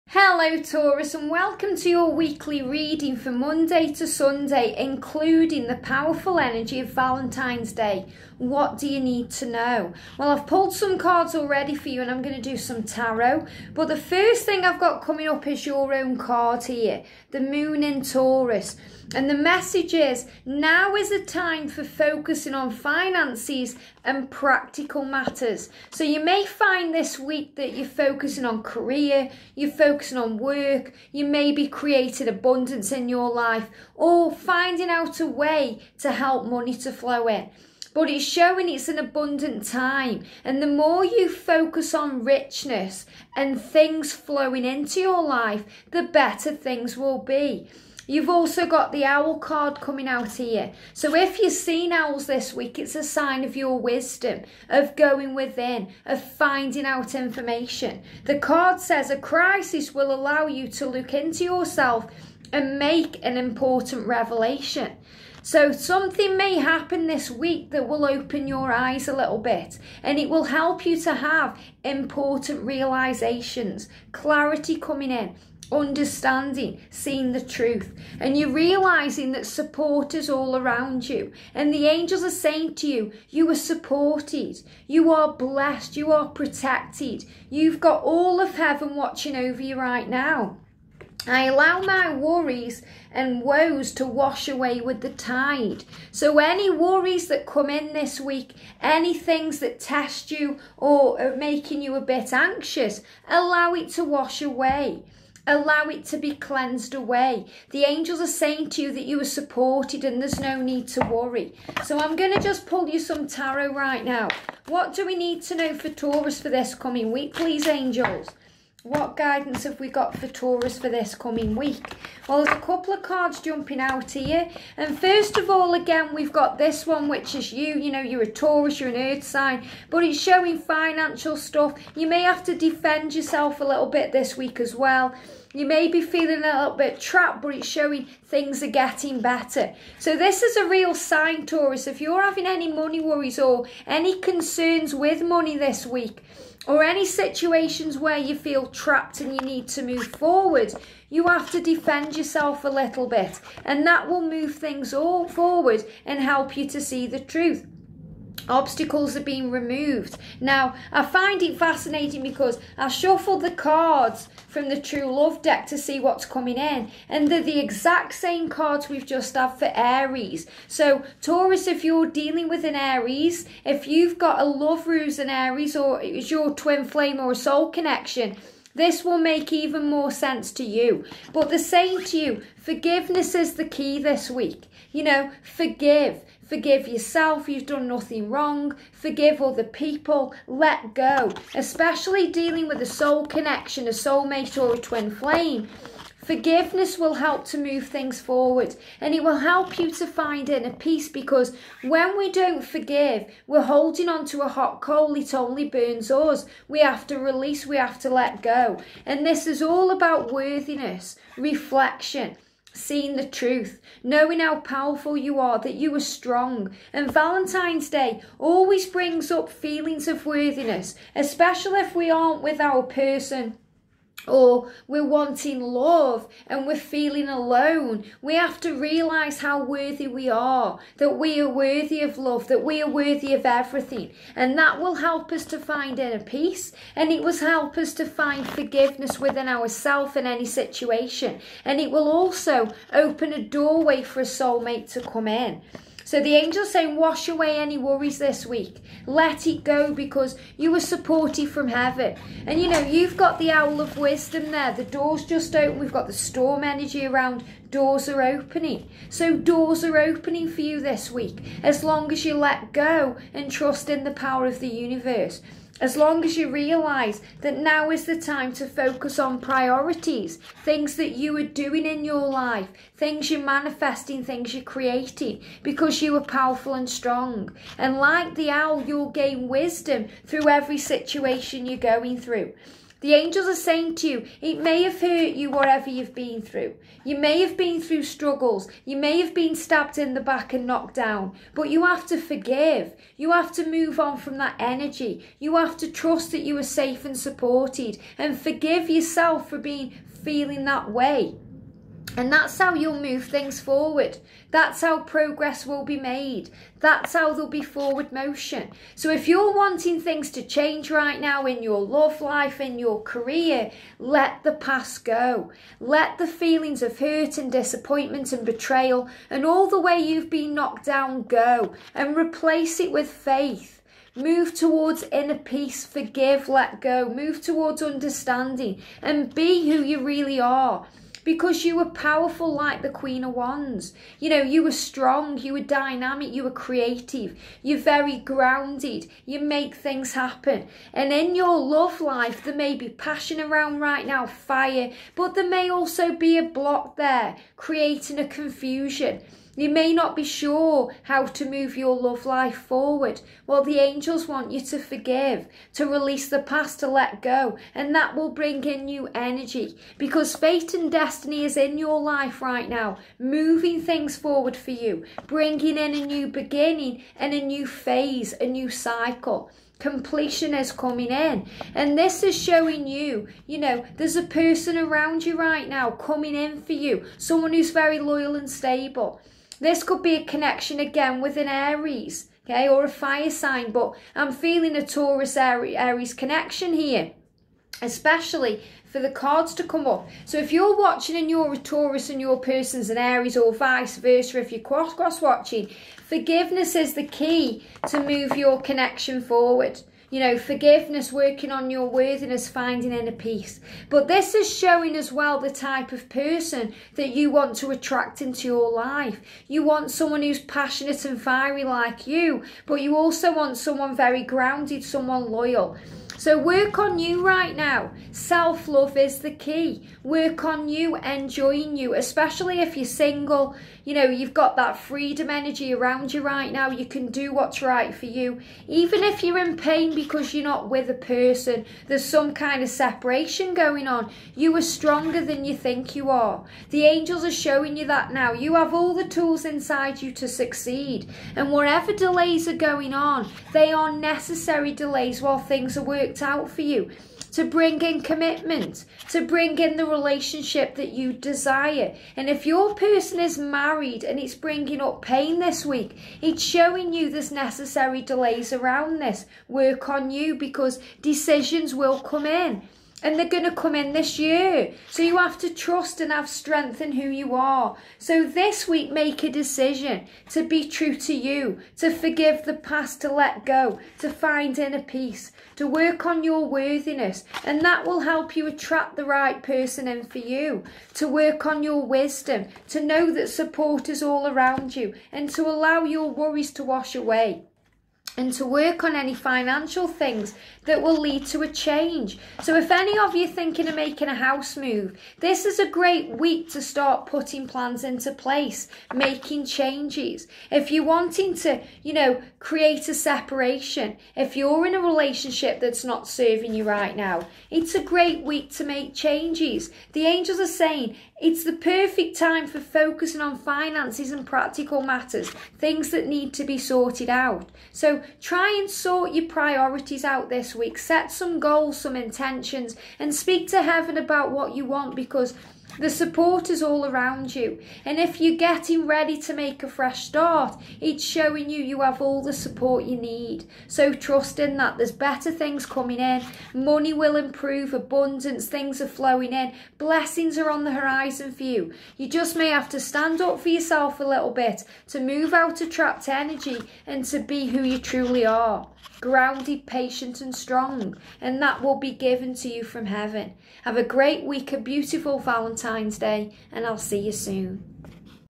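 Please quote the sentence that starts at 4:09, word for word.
Let it go because you were supported from heaven.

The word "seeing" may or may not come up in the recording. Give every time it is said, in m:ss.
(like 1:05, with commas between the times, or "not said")
1:16, 3:32.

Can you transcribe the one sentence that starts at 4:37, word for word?
And like the owl, you'll gain wisdom through every situation you're going through.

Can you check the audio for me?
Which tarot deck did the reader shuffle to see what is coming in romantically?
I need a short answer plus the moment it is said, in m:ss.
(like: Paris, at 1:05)
True Love deck, at 2:44.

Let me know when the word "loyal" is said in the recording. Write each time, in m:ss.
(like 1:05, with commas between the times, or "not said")
6:17, 6:55.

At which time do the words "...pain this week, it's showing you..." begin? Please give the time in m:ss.
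7:35.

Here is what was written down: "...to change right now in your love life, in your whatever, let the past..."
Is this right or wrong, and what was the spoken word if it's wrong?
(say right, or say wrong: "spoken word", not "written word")
wrong: "career", not "whatever".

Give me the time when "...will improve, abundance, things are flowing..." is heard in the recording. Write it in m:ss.
8:56.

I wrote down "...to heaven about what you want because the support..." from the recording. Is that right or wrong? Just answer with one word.
right.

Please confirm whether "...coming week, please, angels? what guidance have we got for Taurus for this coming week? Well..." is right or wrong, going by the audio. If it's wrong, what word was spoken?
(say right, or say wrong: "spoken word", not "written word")
right.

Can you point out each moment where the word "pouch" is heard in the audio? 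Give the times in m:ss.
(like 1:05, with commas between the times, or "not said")
not said.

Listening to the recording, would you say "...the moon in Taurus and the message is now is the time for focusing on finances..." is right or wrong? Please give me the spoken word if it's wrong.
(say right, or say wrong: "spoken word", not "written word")
right.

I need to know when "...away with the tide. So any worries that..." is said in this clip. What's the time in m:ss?
1:34.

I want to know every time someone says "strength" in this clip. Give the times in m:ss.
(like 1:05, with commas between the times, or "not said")
7:46.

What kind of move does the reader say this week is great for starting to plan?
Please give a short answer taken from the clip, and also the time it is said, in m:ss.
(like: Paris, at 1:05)
House move, at 8:14.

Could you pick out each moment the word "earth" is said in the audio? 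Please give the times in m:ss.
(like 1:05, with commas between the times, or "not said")
2:08.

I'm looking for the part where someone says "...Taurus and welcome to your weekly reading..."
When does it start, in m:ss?
0:00.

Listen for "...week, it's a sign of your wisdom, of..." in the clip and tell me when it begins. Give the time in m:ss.
0:52.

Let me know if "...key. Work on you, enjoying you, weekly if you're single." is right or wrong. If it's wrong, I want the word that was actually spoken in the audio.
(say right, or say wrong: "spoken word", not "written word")
wrong: "especially", not "weekly".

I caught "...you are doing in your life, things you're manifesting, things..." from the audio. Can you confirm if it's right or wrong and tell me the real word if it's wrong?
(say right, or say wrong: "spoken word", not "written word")
right.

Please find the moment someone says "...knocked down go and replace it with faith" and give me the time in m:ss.
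5:20.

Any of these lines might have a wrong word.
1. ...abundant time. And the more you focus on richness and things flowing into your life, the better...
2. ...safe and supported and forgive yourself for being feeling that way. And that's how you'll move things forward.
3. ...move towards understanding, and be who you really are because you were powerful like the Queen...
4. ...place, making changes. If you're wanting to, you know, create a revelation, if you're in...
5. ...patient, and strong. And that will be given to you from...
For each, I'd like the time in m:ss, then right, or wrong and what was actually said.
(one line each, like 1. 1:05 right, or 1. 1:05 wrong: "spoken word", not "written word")
1. 0:38 right
2. 4:56 right
3. 5:27 right
4. 8:18 wrong: "separation", not "revelation"
5. 9:09 right.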